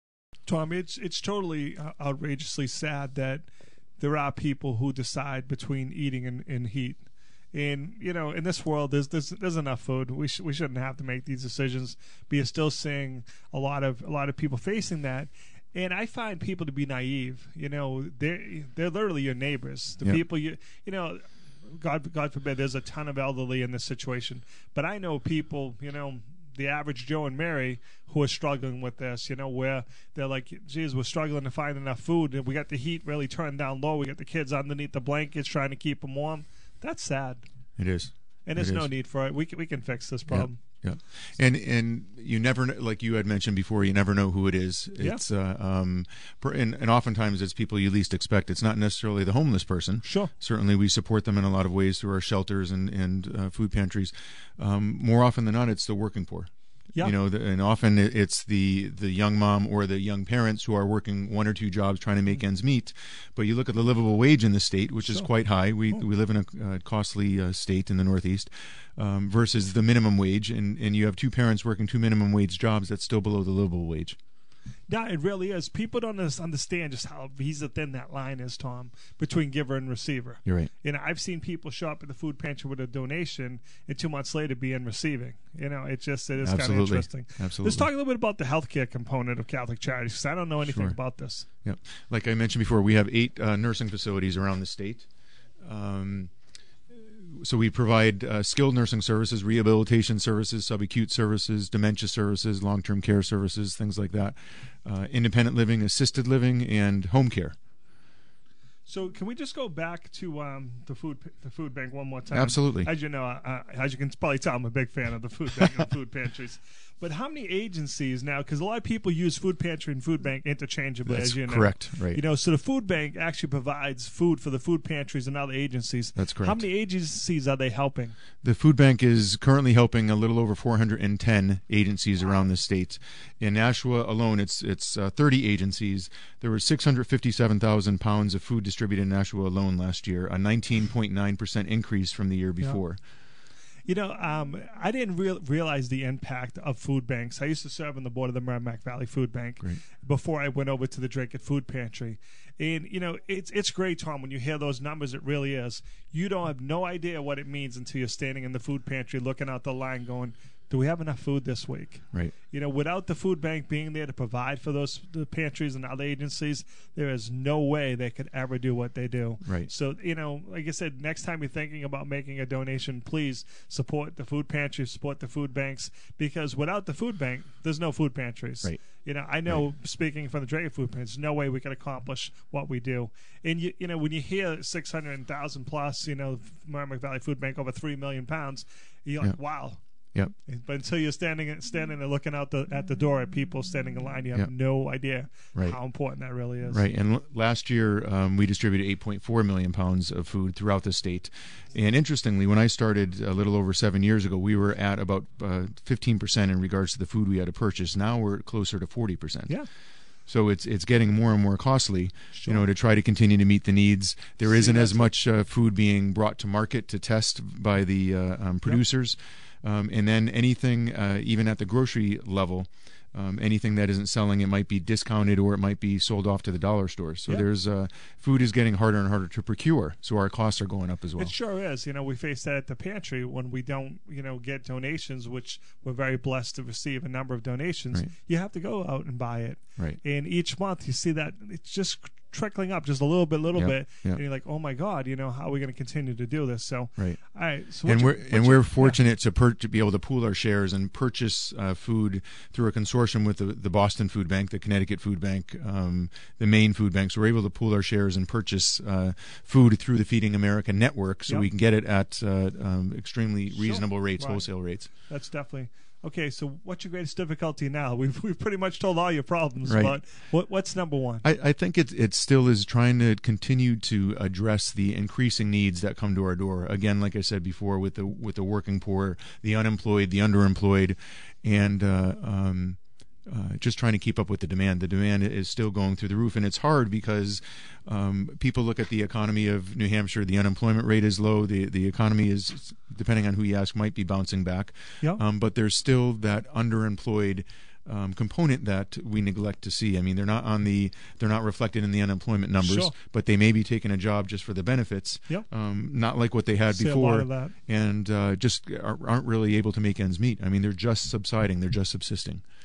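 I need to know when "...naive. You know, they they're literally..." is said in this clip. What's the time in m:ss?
0:16.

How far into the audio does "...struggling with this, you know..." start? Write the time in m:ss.
0:28.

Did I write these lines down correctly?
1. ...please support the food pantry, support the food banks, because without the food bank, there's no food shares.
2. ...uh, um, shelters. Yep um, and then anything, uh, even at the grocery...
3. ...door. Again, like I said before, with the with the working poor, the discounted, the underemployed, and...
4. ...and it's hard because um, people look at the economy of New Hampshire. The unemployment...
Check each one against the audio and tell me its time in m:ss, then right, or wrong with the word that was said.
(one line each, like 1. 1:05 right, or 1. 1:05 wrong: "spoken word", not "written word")
1. 2:53 wrong: "pantries", not "shares"
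2. 3:38 wrong: "producers", not "shelters"
3. 4:36 wrong: "unemployed", not "discounted"
4. 4:46 right.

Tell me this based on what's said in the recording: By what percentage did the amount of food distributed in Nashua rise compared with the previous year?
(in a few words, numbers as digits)
19.9%.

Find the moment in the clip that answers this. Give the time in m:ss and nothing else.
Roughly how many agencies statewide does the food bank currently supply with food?
2:10.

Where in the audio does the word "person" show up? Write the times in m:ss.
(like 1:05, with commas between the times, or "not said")
0:49.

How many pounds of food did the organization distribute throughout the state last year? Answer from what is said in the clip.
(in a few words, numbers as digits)
8.4 million pounds.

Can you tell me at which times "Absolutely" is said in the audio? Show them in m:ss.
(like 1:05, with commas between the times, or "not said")
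1:27, 1:52.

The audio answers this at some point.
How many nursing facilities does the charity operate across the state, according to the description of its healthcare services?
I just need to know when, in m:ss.
1:33.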